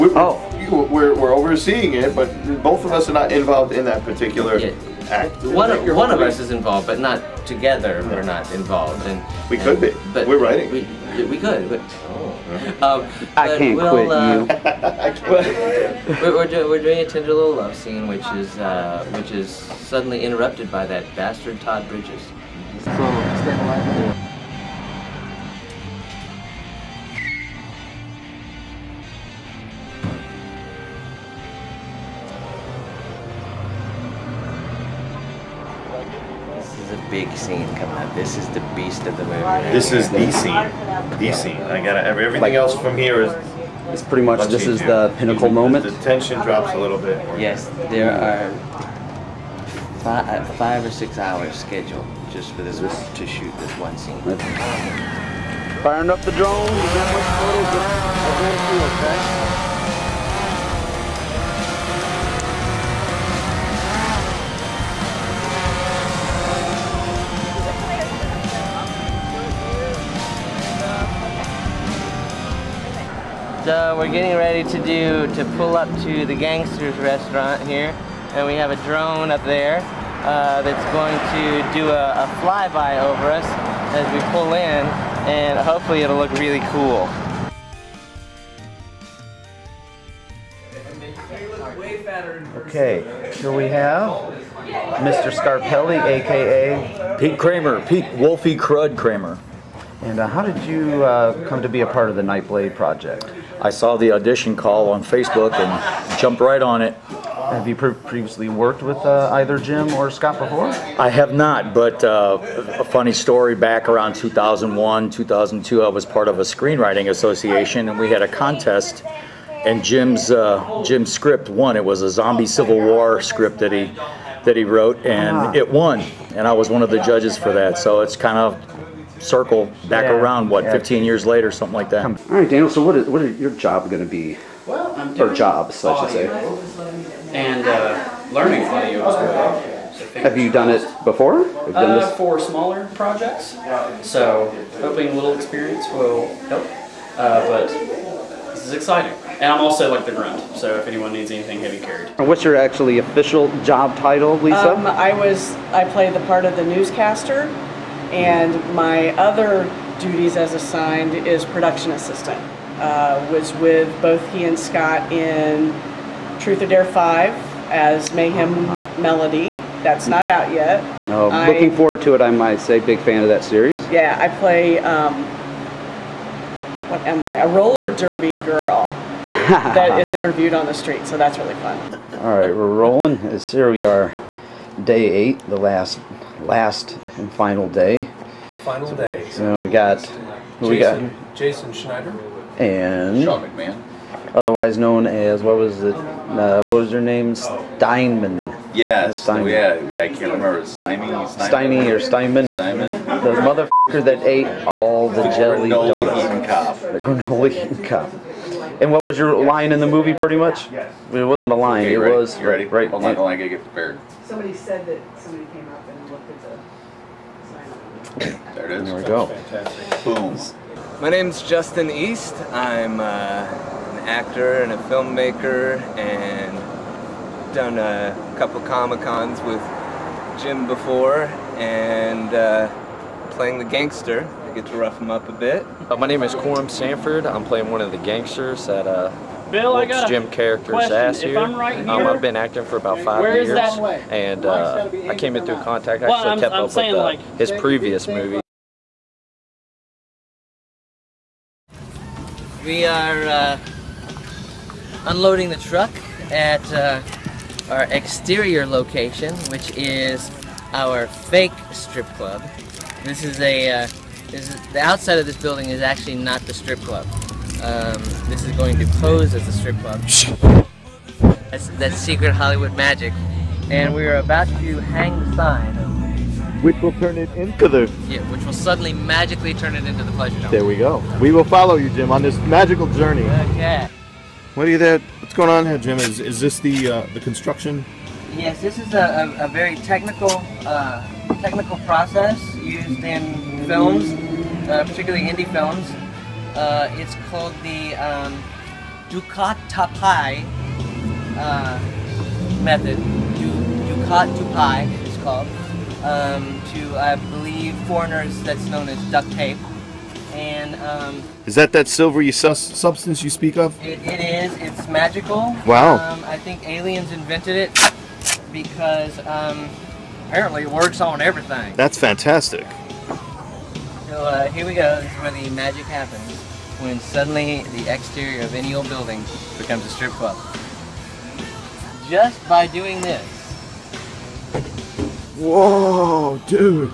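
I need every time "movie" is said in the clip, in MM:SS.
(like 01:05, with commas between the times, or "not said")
00:39, 03:29, 04:08.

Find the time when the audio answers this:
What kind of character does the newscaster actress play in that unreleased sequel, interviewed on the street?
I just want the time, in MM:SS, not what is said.
02:57.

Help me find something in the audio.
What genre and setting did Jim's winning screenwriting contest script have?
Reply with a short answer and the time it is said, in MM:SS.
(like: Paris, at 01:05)
Zombie Civil War, at 02:02.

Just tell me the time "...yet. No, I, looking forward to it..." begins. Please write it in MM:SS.
02:50.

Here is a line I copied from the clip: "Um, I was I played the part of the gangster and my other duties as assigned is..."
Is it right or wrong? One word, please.
wrong.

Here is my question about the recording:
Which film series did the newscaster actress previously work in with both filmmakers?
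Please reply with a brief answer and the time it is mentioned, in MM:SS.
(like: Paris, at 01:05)
Truth or Dare, at 02:46.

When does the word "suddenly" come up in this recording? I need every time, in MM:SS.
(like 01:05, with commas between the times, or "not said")
00:19, 04:38, 05:27.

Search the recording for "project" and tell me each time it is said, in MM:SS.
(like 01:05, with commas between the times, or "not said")
01:42, 02:22.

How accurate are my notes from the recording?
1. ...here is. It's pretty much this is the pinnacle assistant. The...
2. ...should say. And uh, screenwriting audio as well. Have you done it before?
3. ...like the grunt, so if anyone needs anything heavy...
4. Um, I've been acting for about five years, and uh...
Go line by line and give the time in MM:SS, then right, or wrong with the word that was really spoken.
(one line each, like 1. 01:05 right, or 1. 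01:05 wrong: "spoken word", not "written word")
1. 00:42 wrong: "moment", not "assistant"
2. 02:16 wrong: "learning", not "screenwriting"
3. 02:29 right
4. 04:02 right.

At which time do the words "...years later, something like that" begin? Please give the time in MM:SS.
02:11.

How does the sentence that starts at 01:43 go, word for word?
I saw the audition call on Facebook and jumped right on it.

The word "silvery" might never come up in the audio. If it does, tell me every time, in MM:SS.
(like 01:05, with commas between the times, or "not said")
05:11.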